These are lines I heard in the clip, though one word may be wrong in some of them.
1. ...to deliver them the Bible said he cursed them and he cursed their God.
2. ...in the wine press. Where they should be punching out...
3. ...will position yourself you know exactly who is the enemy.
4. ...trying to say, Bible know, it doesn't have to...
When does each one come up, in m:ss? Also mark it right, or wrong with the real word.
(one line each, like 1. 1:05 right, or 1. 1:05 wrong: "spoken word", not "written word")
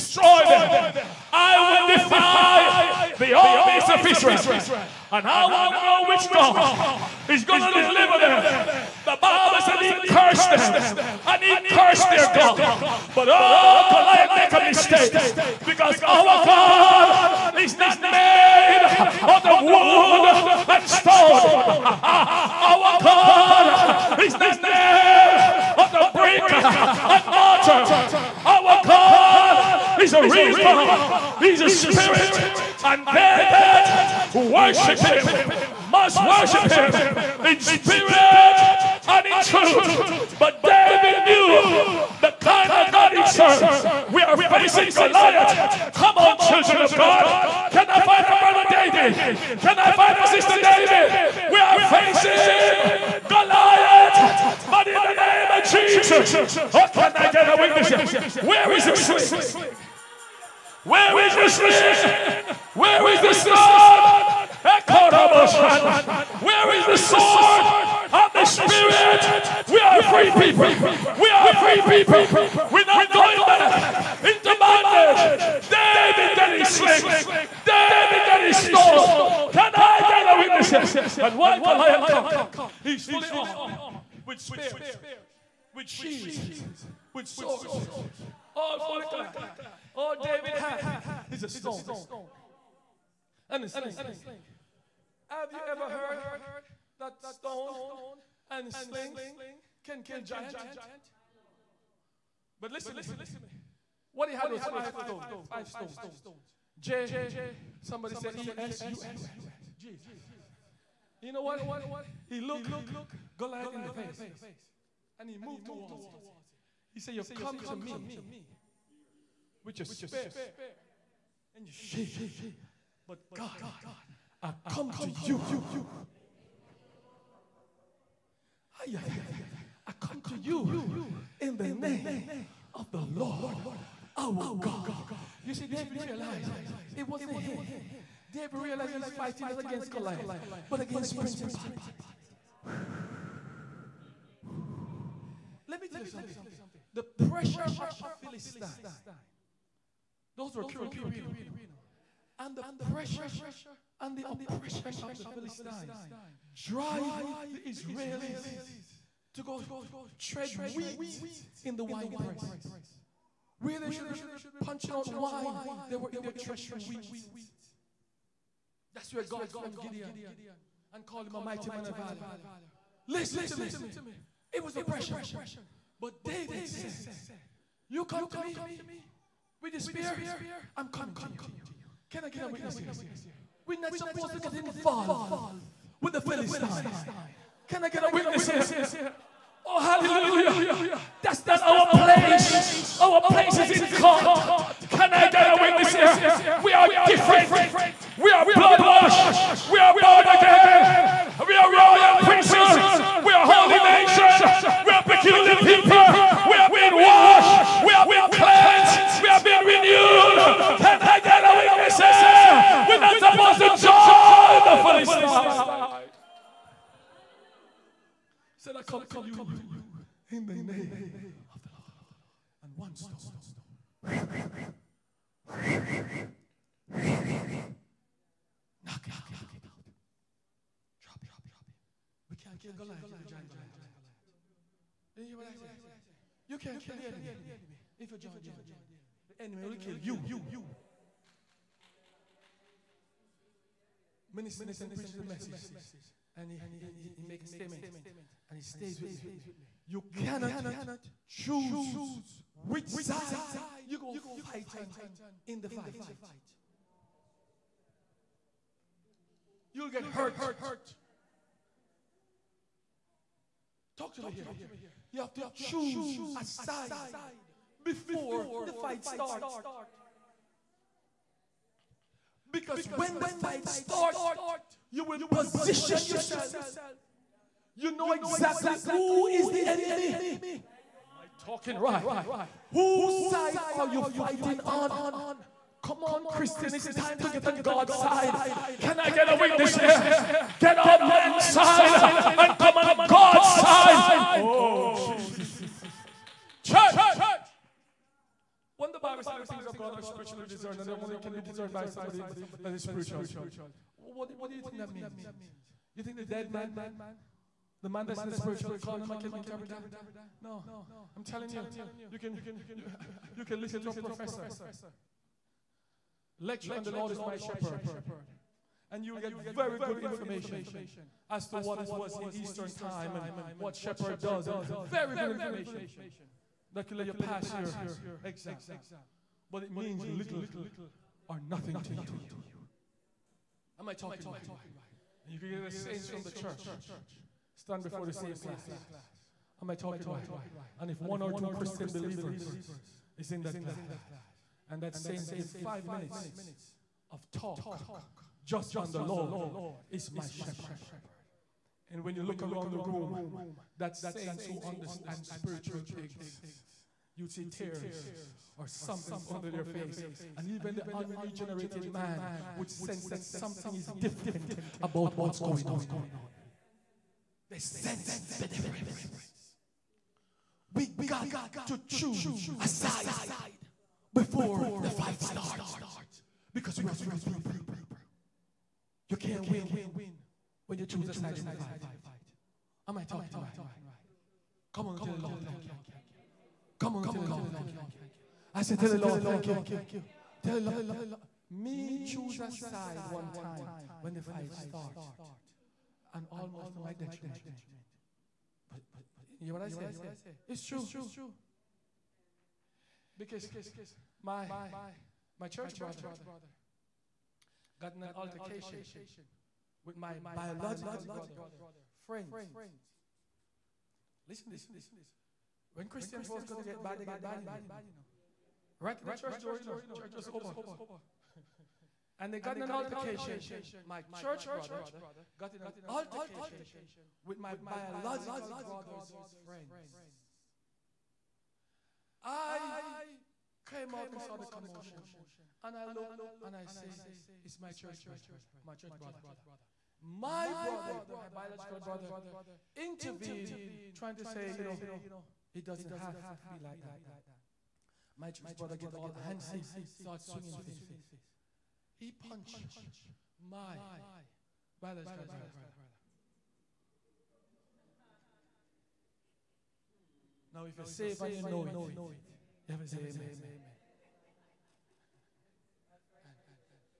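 1. 0:07 right
2. 2:41 right
3. 4:35 right
4. 7:23 wrong: "You", not "Bible".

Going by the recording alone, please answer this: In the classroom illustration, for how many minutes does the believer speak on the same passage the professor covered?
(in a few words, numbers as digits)
5 minutes.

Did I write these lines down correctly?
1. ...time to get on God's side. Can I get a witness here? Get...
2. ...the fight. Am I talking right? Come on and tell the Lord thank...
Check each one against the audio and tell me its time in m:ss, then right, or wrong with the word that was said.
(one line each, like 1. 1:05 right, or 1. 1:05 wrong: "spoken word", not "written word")
1. 4:46 right
2. 6:21 right.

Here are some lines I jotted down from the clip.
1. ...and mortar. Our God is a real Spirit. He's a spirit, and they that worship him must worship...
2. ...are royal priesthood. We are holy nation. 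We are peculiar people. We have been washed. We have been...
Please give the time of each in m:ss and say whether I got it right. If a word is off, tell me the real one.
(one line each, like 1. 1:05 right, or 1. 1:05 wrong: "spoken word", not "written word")
1. 0:26 wrong: "God", not "Spirit"
2. 3:21 right.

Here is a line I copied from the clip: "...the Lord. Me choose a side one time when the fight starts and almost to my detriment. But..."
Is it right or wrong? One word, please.
right.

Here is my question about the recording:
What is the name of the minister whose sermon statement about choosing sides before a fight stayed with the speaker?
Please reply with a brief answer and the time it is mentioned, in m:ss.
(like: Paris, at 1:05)
Minister Nathan, at 4:04.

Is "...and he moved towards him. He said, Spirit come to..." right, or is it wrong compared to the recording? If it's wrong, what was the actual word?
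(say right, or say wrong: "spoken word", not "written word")
wrong: "You", not "Spirit".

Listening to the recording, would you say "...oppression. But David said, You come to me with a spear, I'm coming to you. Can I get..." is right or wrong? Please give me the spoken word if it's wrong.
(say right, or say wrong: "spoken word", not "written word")
right.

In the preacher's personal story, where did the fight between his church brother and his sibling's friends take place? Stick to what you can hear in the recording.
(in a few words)
Church door.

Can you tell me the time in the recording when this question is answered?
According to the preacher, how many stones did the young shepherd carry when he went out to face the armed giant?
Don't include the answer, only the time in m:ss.
1:45.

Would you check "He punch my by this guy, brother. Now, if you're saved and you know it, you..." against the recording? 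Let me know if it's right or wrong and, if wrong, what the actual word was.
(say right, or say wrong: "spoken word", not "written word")
right.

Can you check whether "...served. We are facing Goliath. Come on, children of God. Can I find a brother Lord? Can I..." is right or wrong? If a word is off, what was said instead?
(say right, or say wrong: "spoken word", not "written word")
wrong: "David", not "Lord".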